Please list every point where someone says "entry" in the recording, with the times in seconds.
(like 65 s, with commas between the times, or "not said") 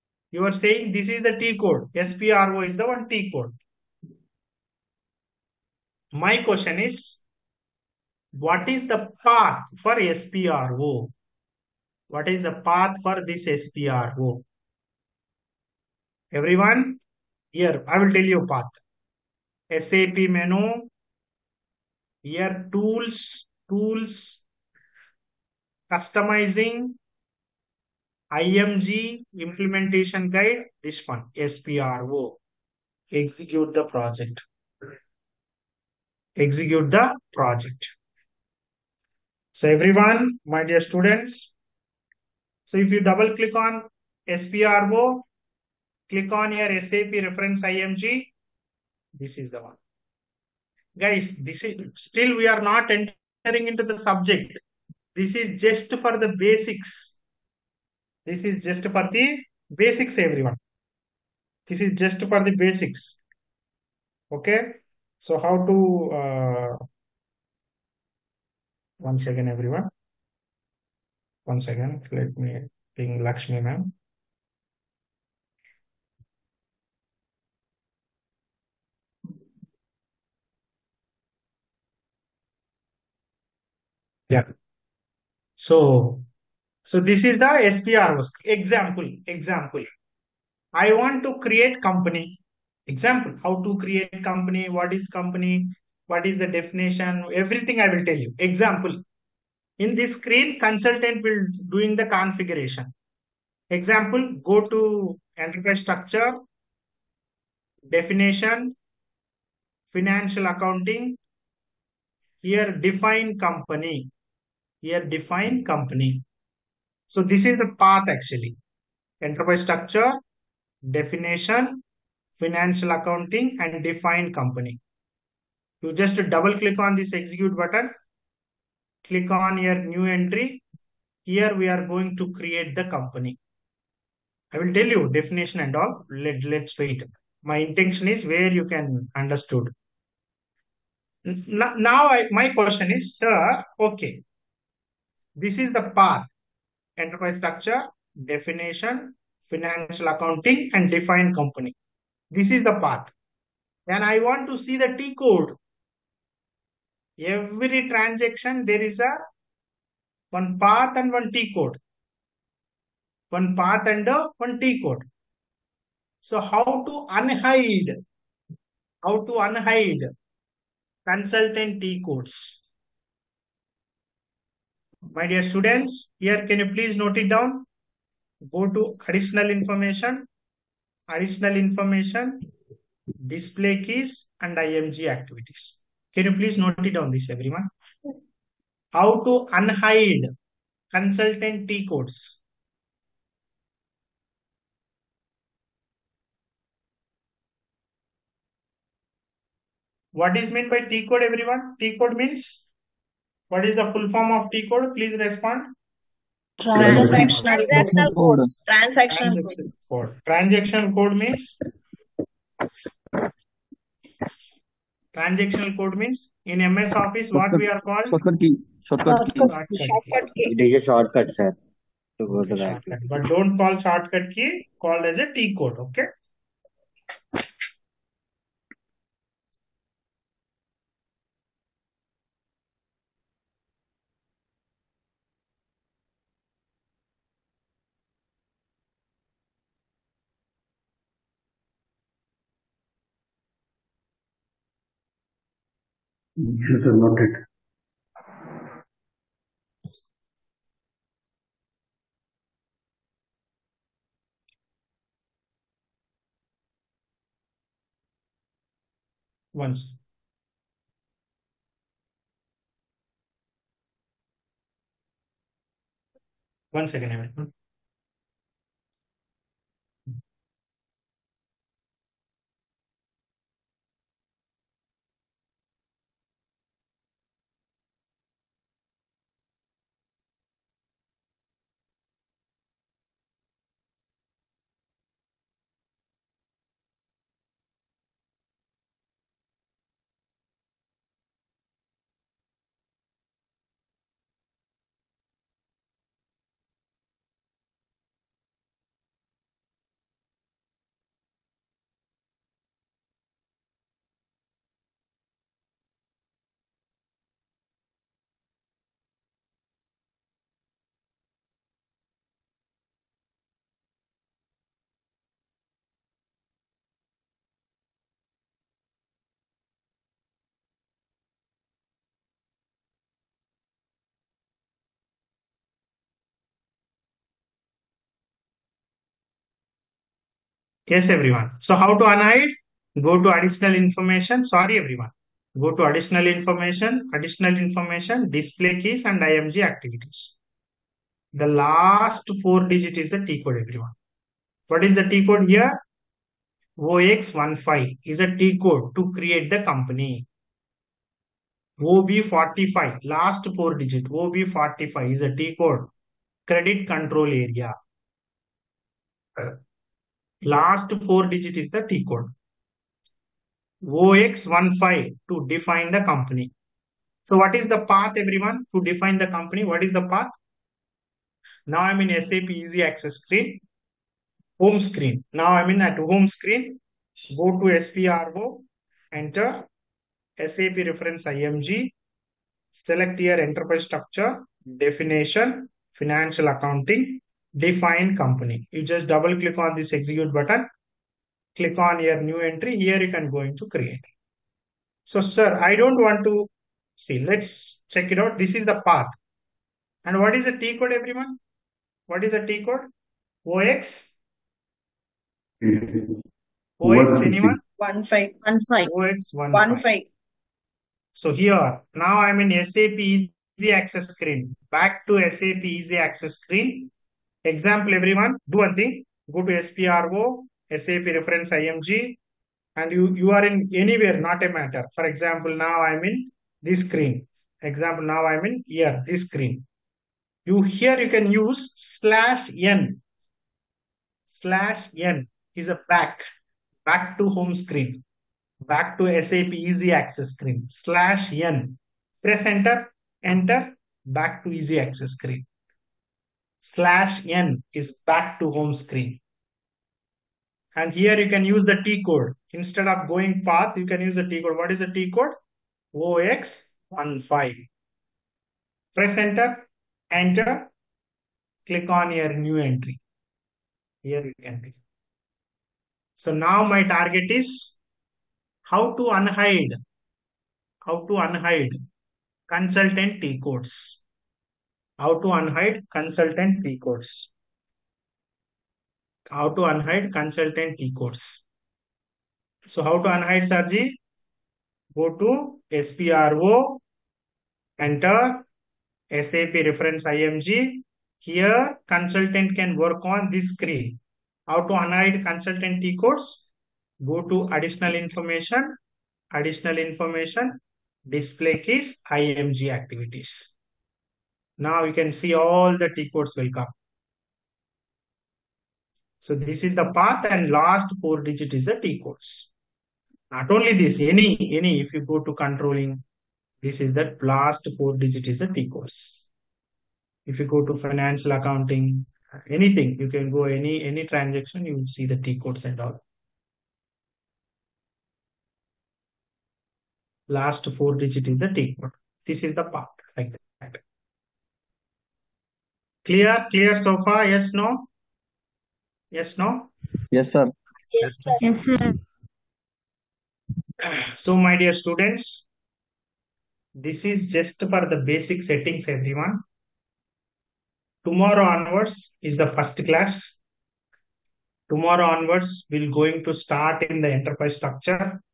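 130 s, 392 s, 462 s.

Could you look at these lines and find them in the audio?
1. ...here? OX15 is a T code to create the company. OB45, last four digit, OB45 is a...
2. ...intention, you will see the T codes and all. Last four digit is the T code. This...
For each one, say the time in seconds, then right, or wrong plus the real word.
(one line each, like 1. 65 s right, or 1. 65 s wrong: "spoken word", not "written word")
1. 345 s right
2. 524 s wrong: "transaction", not "intention".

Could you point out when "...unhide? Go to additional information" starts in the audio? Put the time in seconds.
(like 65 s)
332 s.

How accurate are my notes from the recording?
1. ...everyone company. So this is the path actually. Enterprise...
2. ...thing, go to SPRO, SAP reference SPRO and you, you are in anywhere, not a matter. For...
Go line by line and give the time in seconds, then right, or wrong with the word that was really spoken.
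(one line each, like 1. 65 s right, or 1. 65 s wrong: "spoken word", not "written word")
1. 115 s wrong: "define", not "everyone"
2. 418 s wrong: "IMG", not "SPRO".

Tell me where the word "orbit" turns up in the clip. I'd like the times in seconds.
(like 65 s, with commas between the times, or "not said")
not said.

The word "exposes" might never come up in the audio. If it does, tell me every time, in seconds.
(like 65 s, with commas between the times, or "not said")
not said.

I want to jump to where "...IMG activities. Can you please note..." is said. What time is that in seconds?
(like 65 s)
184 s.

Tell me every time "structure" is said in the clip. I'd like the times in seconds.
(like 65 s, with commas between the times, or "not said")
105 s, 119 s, 147 s, 383 s, 557 s.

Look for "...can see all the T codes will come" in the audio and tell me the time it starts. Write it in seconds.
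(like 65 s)
504 s.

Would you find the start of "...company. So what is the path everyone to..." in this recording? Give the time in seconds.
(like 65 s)
366 s.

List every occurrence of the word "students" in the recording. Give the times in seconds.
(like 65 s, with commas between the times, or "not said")
40 s, 175 s, 544 s.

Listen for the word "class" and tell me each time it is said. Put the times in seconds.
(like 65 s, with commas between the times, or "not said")
552 s.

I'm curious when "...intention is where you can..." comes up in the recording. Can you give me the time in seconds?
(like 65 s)
137 s.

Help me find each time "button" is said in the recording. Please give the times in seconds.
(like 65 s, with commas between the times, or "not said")
127 s, 390 s.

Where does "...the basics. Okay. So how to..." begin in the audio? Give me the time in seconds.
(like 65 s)
62 s.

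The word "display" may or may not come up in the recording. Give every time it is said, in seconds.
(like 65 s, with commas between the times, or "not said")
183 s, 338 s, 501 s.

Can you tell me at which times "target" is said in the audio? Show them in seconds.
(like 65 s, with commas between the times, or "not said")
466 s.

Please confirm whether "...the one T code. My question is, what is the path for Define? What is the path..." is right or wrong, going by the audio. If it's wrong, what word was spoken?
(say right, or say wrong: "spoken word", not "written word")
wrong: "SPRO", not "Define".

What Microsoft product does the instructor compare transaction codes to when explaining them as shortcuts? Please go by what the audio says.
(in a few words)
MS Office.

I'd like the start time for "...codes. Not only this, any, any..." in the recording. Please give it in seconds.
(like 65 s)
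512 s.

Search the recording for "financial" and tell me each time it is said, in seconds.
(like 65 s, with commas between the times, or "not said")
109 s, 122 s, 149 s, 385 s, 520 s.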